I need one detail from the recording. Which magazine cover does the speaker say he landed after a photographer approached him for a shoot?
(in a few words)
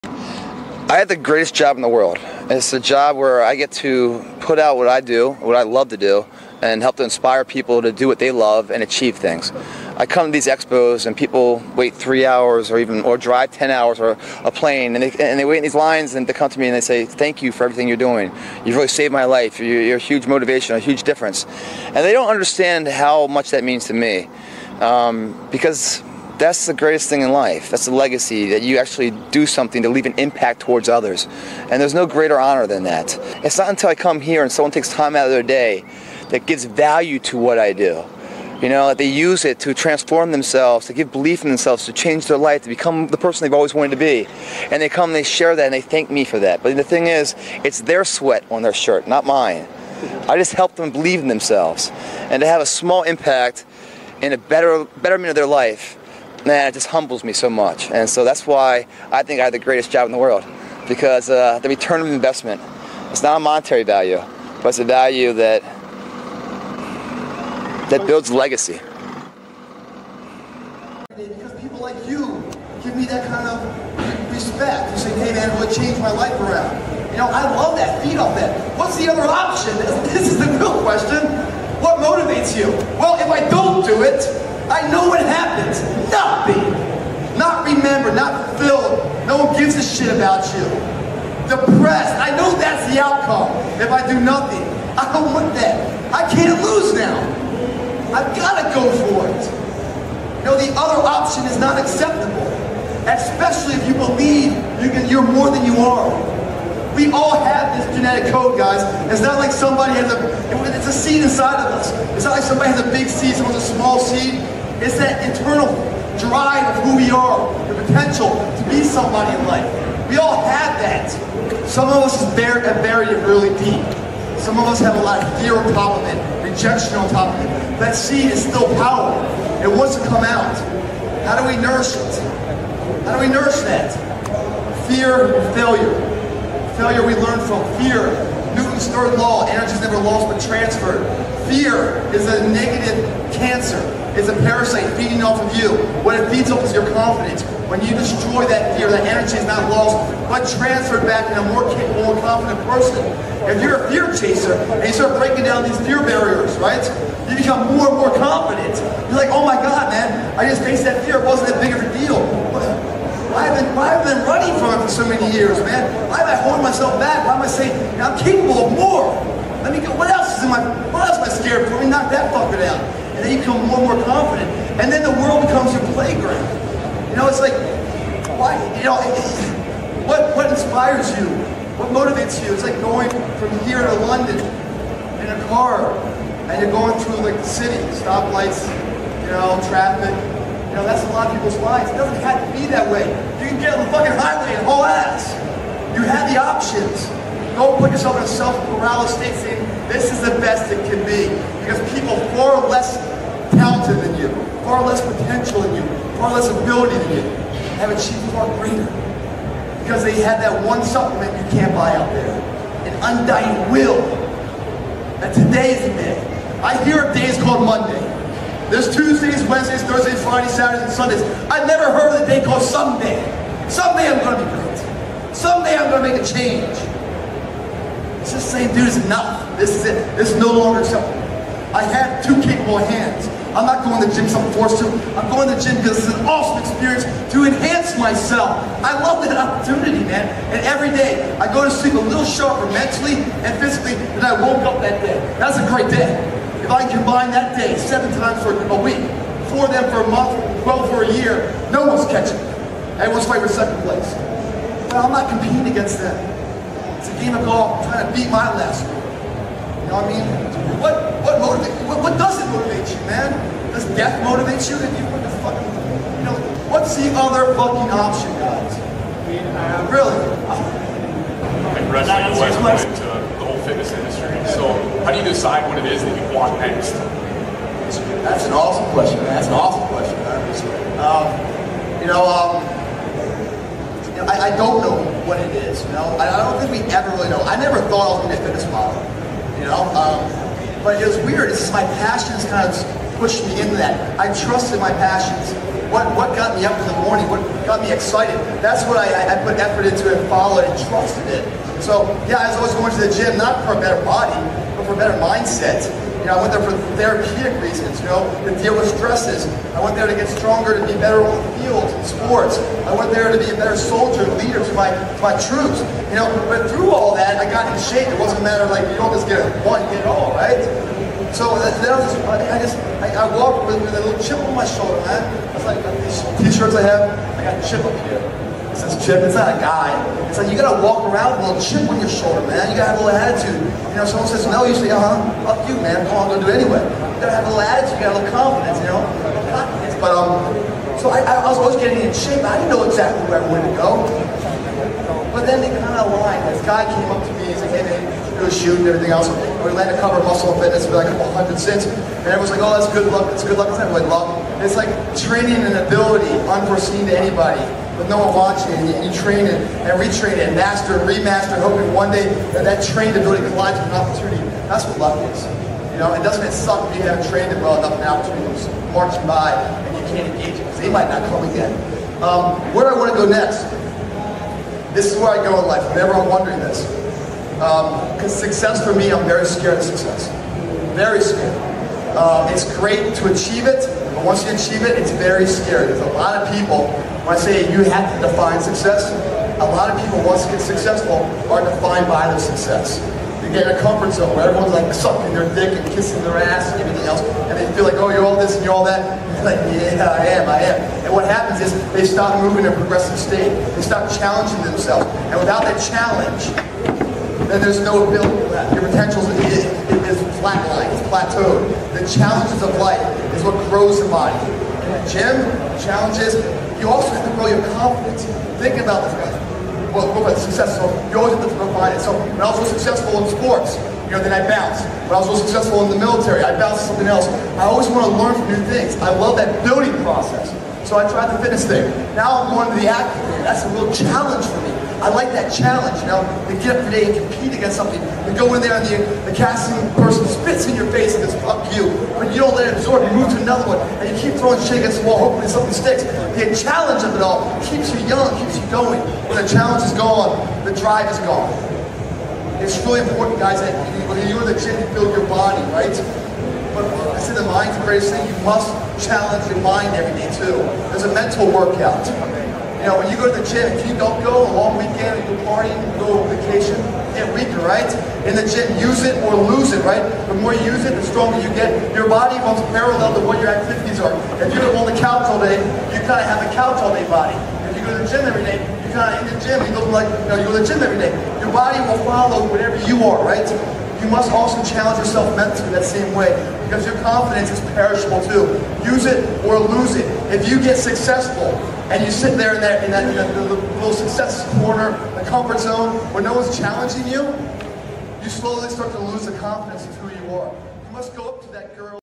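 Muscle and Fitness.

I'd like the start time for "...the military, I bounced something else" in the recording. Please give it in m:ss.
7:05.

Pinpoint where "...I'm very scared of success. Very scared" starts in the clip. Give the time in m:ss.
6:19.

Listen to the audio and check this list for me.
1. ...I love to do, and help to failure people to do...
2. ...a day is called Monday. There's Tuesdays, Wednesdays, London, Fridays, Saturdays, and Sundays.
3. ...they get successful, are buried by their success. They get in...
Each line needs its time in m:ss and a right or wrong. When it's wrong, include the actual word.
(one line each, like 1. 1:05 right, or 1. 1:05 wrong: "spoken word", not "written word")
1. 0:05 wrong: "inspire", not "failure"
2. 3:37 wrong: "Thursdays", not "London"
3. 6:30 wrong: "defined", not "buried".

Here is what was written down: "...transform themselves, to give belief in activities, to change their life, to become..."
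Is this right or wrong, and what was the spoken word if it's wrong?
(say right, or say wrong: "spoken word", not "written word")
wrong: "themselves", not "activities".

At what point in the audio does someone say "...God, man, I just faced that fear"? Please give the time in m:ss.
2:39.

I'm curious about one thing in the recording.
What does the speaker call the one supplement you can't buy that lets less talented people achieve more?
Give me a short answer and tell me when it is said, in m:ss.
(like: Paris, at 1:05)
An undying will, at 3:32.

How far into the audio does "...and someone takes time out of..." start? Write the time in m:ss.
0:34.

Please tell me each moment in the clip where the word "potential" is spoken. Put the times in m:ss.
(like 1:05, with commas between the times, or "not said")
1:57, 3:25, 6:48.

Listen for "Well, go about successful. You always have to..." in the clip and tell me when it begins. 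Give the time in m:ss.
6:59.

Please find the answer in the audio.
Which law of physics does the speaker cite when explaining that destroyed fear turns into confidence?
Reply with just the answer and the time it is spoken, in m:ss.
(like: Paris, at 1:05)
Newton's third law, at 2:18.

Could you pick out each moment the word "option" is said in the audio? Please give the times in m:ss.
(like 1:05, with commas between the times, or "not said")
1:19, 1:41, 3:16, 4:27.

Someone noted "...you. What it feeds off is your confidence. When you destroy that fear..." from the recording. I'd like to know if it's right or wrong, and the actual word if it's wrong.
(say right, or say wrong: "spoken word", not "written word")
right.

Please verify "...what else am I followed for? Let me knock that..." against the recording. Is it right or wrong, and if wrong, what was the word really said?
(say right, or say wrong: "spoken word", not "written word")
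wrong: "scared", not "followed".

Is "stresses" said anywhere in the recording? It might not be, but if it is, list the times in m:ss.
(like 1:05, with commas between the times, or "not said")
5:08.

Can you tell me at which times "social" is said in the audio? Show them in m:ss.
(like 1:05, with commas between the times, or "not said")
not said.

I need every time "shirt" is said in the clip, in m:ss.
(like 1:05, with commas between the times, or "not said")
0:48, 5:26.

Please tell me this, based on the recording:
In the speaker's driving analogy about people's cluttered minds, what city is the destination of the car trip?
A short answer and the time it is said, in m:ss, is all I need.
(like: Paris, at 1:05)
London, at 3:04.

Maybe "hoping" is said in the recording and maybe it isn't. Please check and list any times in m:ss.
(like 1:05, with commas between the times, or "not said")
6:01, 7:25.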